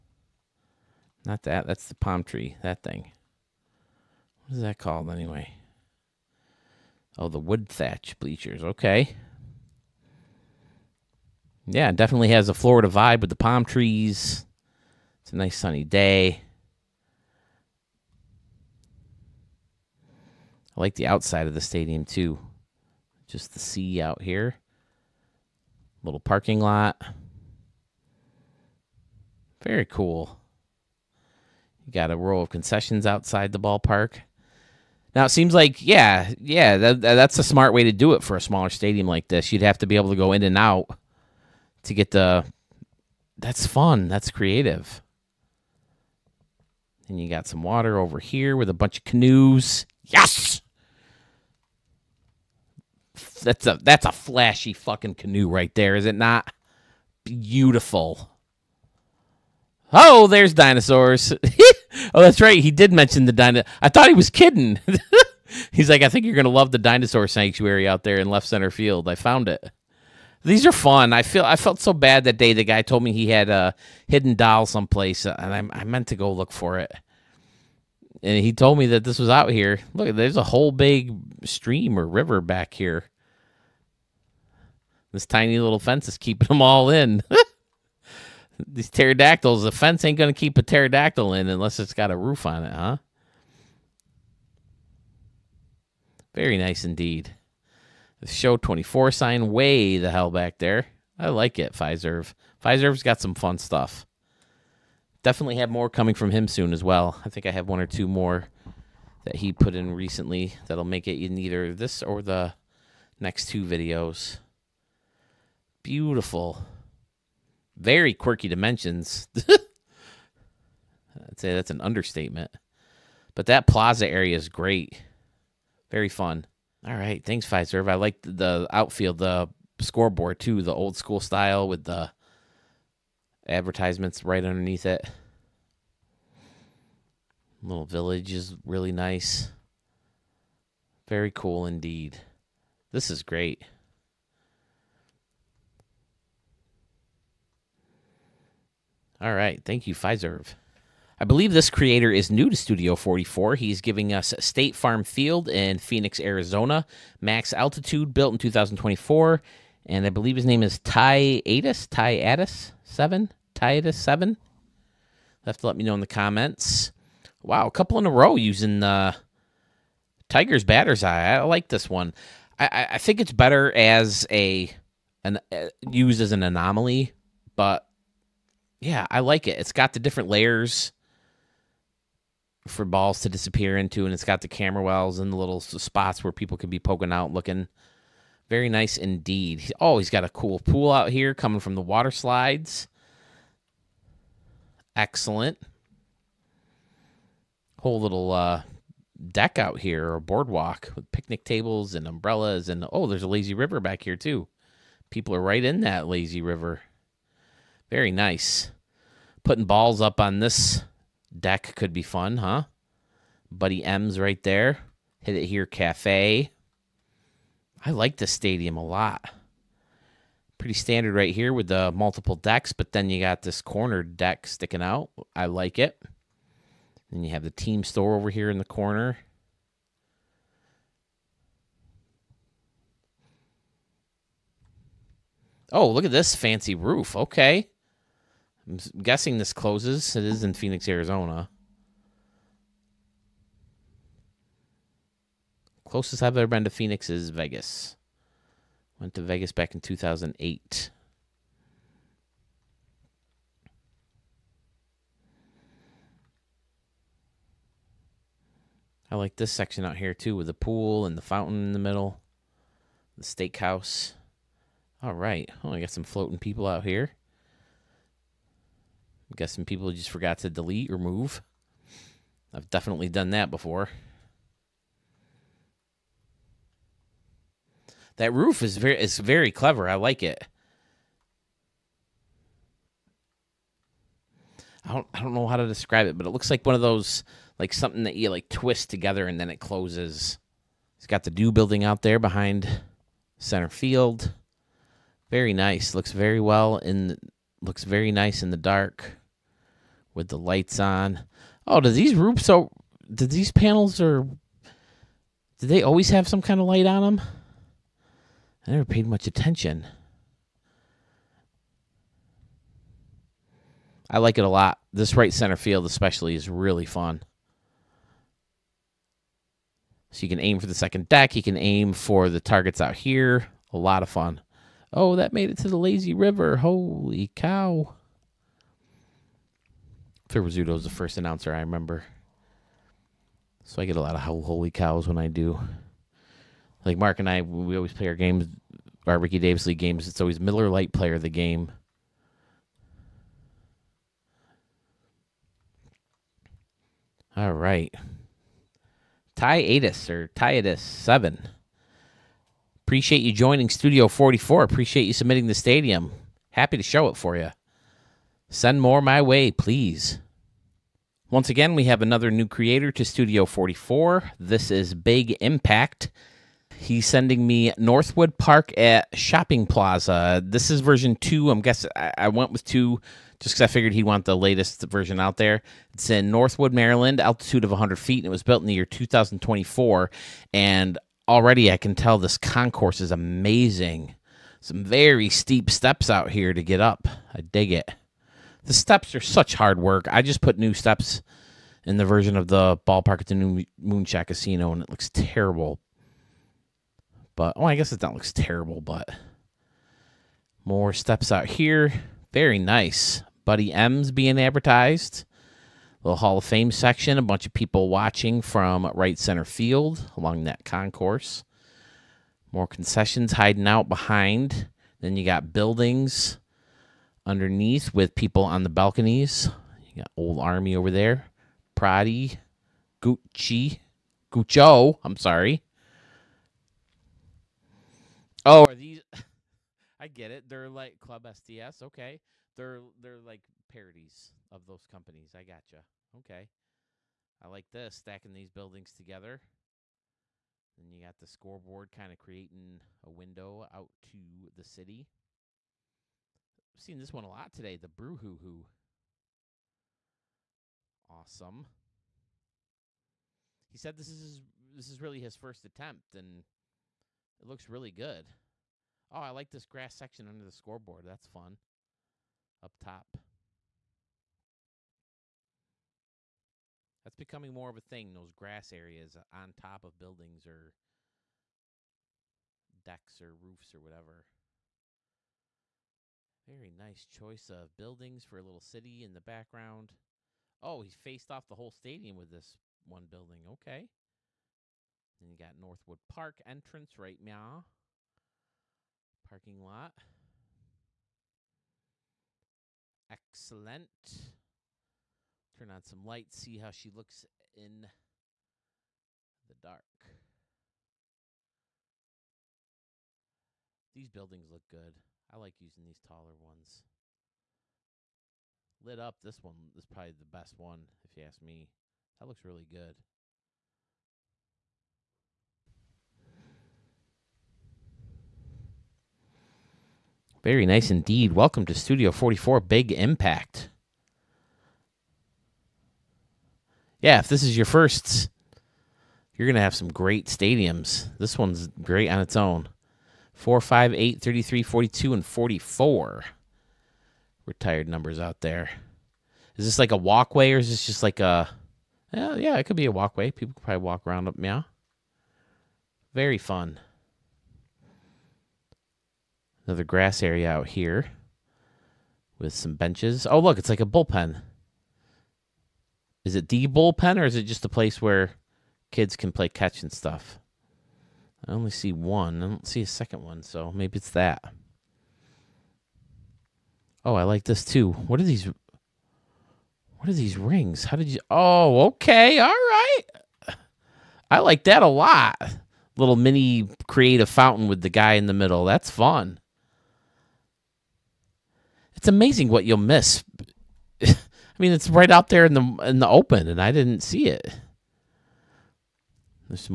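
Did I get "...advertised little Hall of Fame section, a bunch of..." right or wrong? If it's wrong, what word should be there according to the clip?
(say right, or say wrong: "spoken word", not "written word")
right.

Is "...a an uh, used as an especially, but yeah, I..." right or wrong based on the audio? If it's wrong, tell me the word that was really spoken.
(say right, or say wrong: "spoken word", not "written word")
wrong: "anomaly", not "especially".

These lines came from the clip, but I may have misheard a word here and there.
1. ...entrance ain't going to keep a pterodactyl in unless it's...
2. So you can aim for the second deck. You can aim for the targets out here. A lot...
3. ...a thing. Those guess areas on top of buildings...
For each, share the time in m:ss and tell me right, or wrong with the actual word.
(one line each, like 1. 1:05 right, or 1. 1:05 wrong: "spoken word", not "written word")
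1. 1:29 wrong: "fence", not "entrance"
2. 5:20 right
3. 7:47 wrong: "grass", not "guess".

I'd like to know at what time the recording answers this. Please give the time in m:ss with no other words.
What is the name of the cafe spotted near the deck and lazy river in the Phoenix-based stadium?
3:35.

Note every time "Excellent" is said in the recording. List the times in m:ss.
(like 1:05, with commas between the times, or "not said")
3:14, 8:13.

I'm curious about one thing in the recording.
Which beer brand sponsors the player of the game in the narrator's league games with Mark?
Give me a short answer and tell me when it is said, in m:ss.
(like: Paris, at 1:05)
Miller Lite, at 5:40.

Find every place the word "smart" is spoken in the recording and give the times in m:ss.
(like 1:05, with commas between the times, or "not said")
0:37.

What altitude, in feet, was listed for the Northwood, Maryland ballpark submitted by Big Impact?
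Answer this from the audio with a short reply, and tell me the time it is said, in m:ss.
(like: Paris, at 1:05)
100 feet, at 6:17.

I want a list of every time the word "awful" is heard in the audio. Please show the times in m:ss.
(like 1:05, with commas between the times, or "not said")
not said.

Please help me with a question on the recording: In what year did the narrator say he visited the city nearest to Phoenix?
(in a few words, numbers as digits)
2008.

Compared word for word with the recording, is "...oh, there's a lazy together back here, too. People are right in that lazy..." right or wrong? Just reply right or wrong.
wrong.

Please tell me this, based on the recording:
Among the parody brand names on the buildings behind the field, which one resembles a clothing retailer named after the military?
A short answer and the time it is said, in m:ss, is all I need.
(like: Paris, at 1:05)
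Old Army, at 7:00.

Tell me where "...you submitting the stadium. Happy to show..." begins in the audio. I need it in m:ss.
5:55.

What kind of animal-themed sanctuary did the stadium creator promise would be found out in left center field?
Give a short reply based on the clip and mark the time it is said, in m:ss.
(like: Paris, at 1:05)
dinosaur sanctuary, at 1:06.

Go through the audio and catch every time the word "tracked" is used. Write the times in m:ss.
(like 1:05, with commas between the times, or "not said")
not said.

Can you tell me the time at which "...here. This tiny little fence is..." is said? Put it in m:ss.
1:22.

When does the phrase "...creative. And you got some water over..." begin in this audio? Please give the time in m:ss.
0:44.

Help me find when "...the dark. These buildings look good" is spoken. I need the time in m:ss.
8:19.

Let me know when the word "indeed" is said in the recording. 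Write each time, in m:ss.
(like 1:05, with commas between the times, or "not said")
1:36, 2:21, 3:08, 8:40.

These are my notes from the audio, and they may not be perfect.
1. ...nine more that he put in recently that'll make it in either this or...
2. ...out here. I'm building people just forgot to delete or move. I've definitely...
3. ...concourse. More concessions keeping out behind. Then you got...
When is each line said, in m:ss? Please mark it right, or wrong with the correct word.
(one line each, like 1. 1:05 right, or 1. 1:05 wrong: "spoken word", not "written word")
1. 1:47 wrong: "two", not "nine"
2. 4:26 wrong: "guessing", not "building"
3. 6:50 wrong: "hiding", not "keeping".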